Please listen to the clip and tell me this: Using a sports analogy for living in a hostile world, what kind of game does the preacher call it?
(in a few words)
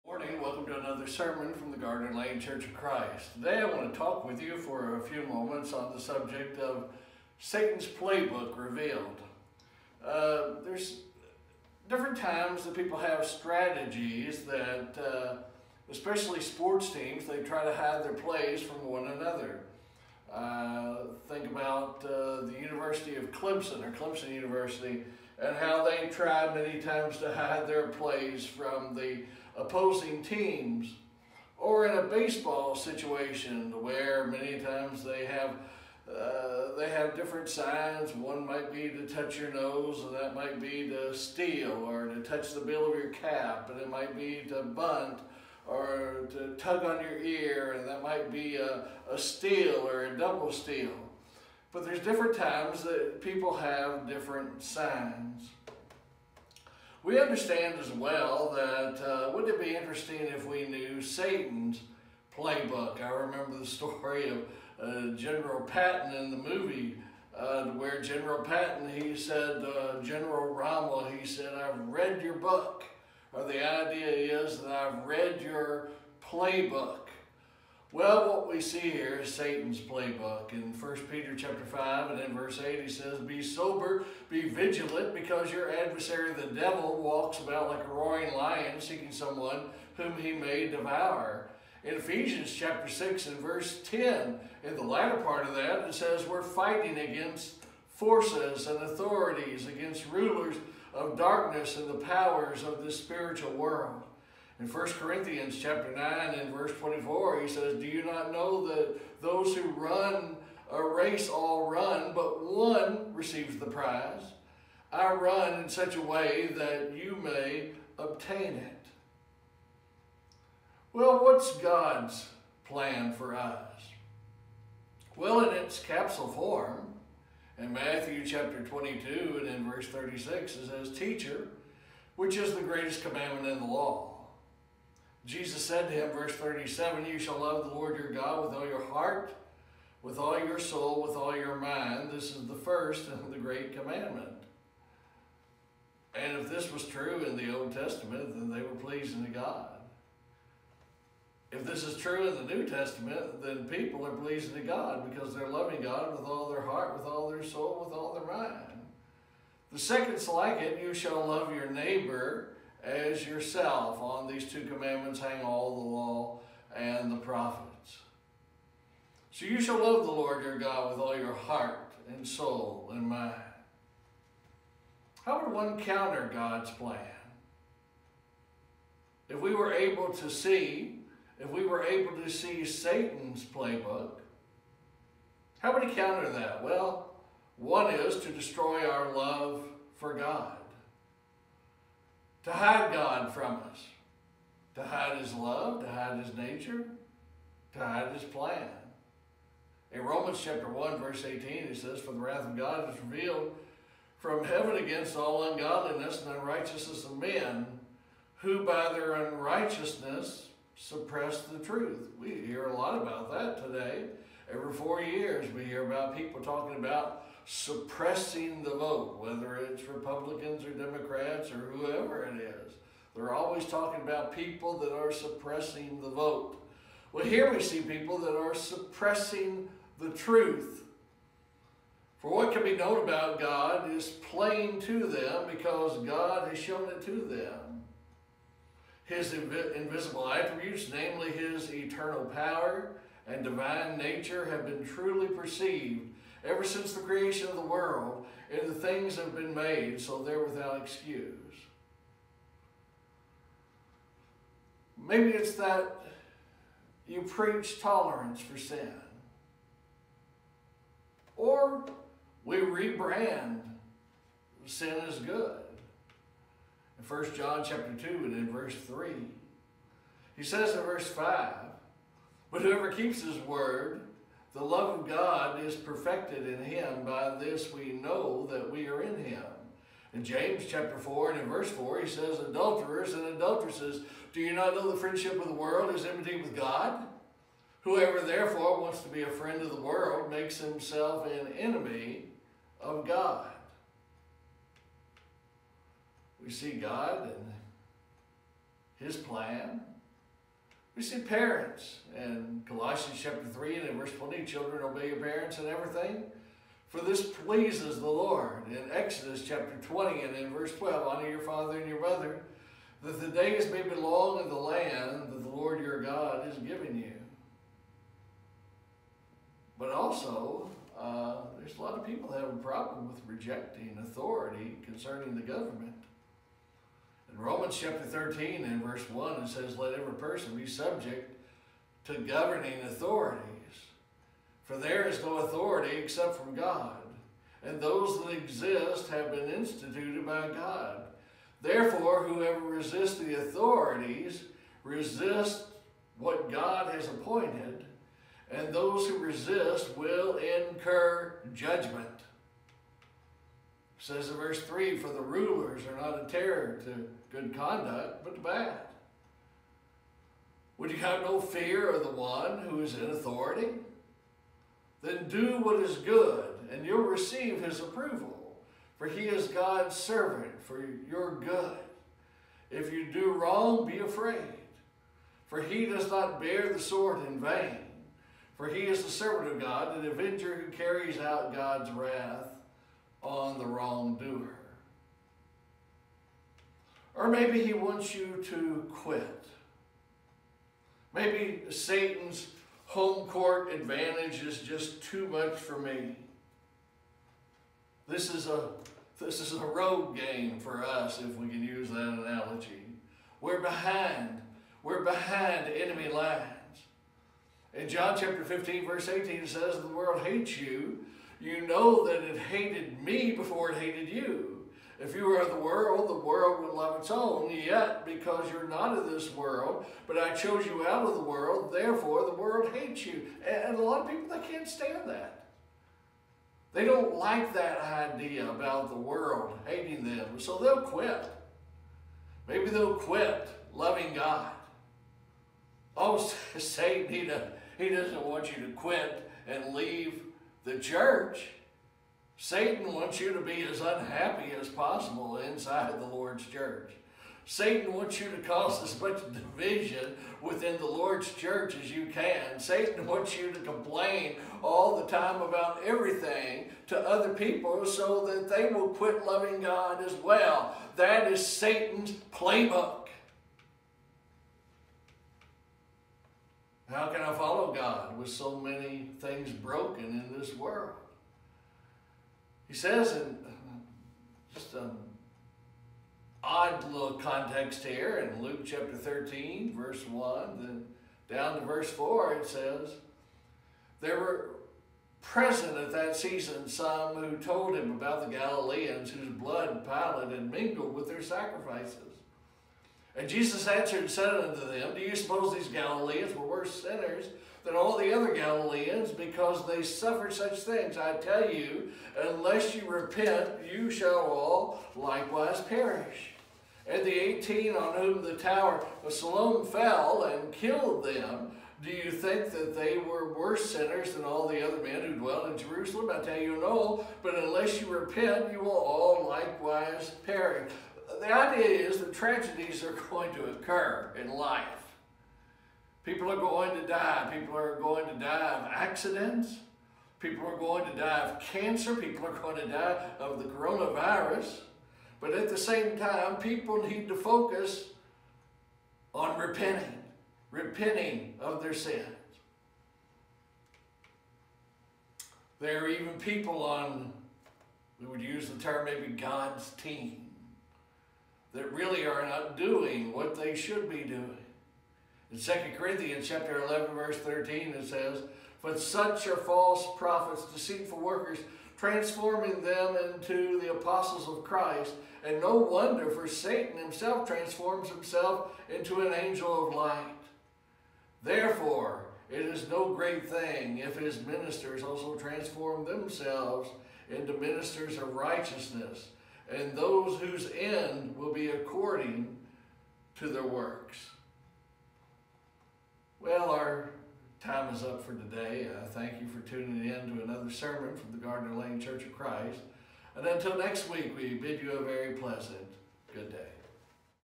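a road game.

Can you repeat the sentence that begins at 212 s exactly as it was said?
We hear a lot about that today.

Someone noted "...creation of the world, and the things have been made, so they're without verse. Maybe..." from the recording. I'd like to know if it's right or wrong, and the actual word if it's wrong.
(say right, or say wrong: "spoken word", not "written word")
wrong: "excuse", not "verse".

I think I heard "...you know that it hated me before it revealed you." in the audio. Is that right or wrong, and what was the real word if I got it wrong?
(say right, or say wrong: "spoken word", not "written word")
wrong: "hated", not "revealed".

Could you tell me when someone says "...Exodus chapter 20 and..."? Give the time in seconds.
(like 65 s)
308 s.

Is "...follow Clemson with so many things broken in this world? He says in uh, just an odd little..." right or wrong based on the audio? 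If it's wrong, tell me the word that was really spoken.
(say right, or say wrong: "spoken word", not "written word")
wrong: "God", not "Clemson".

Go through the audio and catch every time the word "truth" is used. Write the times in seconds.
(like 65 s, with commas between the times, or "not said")
211 s, 230 s.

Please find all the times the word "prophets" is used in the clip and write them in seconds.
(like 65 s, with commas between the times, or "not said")
167 s, 559 s.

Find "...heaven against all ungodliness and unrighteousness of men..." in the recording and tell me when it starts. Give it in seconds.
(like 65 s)
204 s.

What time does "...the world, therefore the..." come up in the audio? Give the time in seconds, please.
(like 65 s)
421 s.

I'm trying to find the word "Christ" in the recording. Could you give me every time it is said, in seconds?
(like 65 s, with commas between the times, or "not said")
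2 s, 564 s, 592 s.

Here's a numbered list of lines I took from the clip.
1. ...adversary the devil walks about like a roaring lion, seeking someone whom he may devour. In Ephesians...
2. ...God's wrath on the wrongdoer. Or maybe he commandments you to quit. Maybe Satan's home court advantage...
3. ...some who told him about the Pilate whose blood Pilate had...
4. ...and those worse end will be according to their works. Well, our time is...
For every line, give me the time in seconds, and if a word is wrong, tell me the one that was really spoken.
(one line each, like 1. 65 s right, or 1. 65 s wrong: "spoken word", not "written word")
1. 85 s right
2. 381 s wrong: "wants", not "commandments"
3. 486 s wrong: "Galileans", not "Pilate"
4. 579 s wrong: "whose", not "worse".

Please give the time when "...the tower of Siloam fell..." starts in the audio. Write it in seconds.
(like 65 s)
508 s.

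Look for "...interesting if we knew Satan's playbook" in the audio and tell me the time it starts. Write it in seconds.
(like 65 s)
59 s.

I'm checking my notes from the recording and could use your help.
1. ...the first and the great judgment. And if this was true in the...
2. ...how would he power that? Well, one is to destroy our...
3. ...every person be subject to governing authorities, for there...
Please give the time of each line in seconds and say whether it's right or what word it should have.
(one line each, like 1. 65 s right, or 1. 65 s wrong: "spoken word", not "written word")
1. 142 s wrong: "commandment", not "judgment"
2. 185 s wrong: "counter", not "power"
3. 329 s right.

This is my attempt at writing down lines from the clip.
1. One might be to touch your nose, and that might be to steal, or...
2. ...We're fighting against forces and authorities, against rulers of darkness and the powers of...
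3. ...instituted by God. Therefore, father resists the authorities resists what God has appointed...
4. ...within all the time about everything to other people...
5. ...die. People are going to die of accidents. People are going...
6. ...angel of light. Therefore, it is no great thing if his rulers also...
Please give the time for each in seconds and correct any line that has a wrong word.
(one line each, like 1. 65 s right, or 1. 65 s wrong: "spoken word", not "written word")
1. 38 s right
2. 96 s right
3. 339 s wrong: "whoever", not "father"
4. 453 s wrong: "complain", not "within"
5. 526 s right
6. 569 s wrong: "ministers", not "rulers".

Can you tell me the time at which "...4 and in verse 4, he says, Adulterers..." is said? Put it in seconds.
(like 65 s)
280 s.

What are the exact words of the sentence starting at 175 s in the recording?
How would one counter God's plan?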